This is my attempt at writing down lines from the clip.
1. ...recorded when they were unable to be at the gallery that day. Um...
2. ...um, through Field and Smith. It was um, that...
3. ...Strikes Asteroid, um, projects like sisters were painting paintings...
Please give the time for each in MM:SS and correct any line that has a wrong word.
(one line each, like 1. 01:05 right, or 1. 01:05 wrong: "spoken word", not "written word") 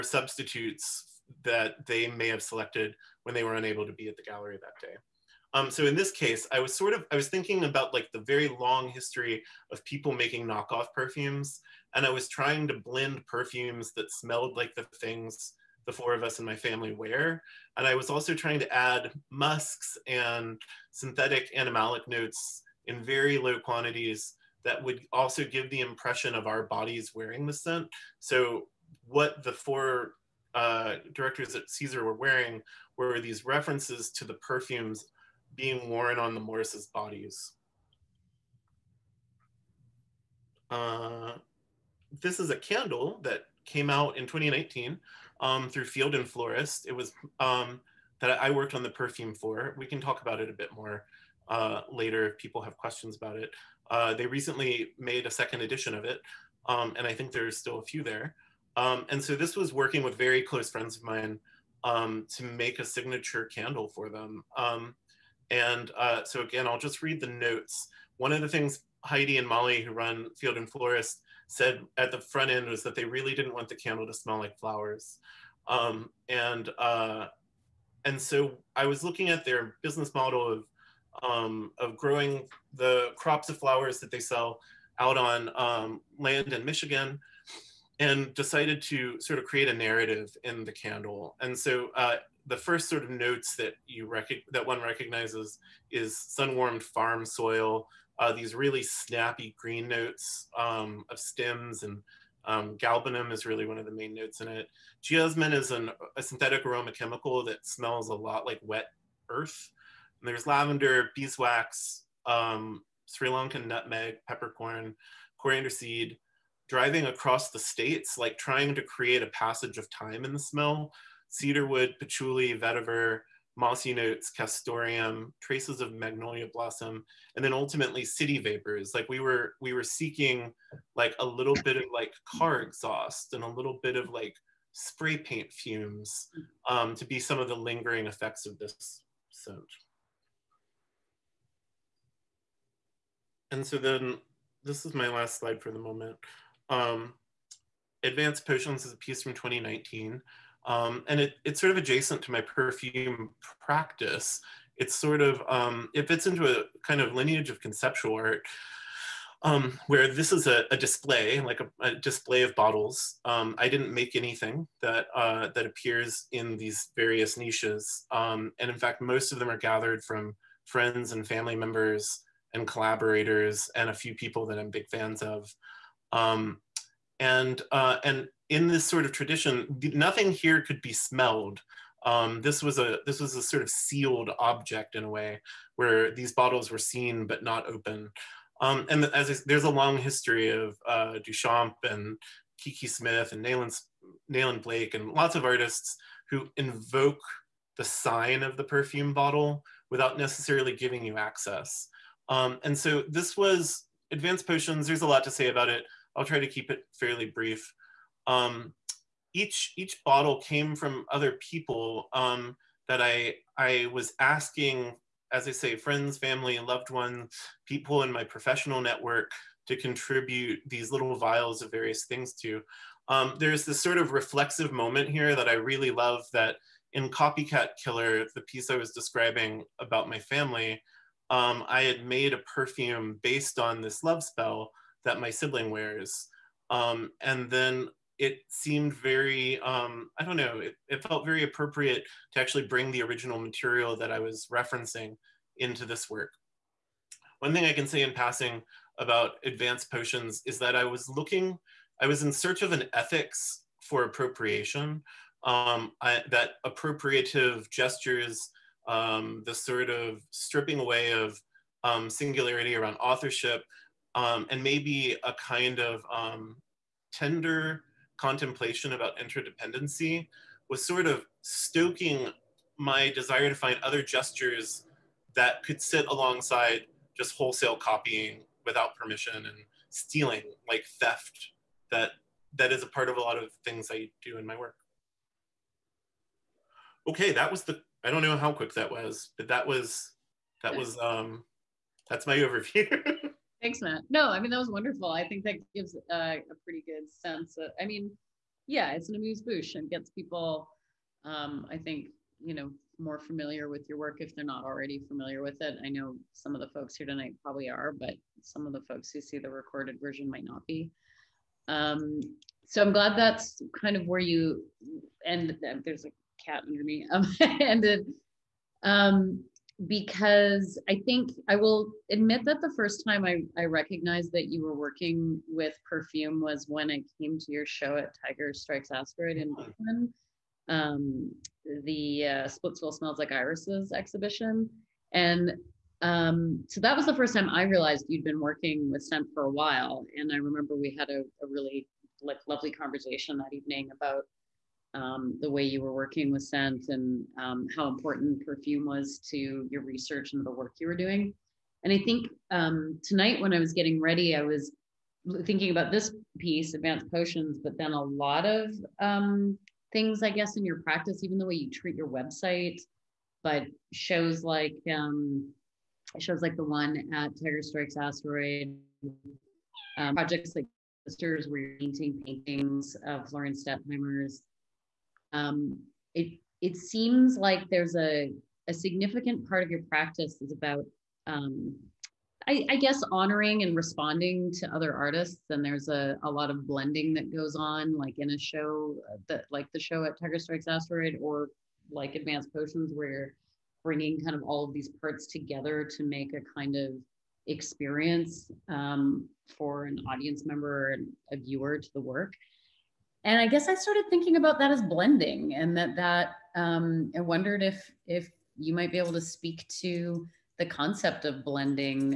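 1. 00:02 wrong: "selected", not "recorded"
2. 00:45 wrong: "Florist", not "Smith"
3. 06:07 right.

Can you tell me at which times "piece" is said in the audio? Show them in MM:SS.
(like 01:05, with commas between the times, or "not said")
02:28, 03:48, 05:56.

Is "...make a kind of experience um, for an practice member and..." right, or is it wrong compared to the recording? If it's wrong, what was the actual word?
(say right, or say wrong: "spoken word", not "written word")
wrong: "audience", not "practice".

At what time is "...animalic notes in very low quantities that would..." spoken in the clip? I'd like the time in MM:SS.
00:21.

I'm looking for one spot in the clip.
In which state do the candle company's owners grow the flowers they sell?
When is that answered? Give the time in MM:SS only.
01:26.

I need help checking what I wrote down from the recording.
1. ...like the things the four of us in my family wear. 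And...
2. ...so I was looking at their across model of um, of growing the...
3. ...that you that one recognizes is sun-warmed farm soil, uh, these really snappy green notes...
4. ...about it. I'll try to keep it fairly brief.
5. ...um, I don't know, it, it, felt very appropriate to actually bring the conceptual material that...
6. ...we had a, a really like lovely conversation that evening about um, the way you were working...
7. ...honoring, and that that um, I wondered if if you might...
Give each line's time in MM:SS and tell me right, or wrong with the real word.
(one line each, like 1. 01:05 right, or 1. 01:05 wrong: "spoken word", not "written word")
1. 00:14 right
2. 01:18 wrong: "business", not "across"
3. 01:33 right
4. 03:25 right
5. 03:59 wrong: "original", not "conceptual"
6. 05:40 right
7. 06:44 wrong: "blending", not "honoring".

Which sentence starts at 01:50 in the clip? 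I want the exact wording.
And there's lavender, beeswax, um, Sri Lankan nutmeg, peppercorn, coriander seed.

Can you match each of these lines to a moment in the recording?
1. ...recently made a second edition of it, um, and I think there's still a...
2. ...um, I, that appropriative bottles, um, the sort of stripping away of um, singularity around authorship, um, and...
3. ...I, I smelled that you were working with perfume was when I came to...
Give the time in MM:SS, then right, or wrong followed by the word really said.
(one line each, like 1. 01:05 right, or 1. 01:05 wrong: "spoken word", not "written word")
1. 00:54 right
2. 04:15 wrong: "gestures", not "bottles"
3. 05:23 wrong: "recognized", not "smelled".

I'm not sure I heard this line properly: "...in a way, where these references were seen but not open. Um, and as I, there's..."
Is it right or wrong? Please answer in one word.
wrong.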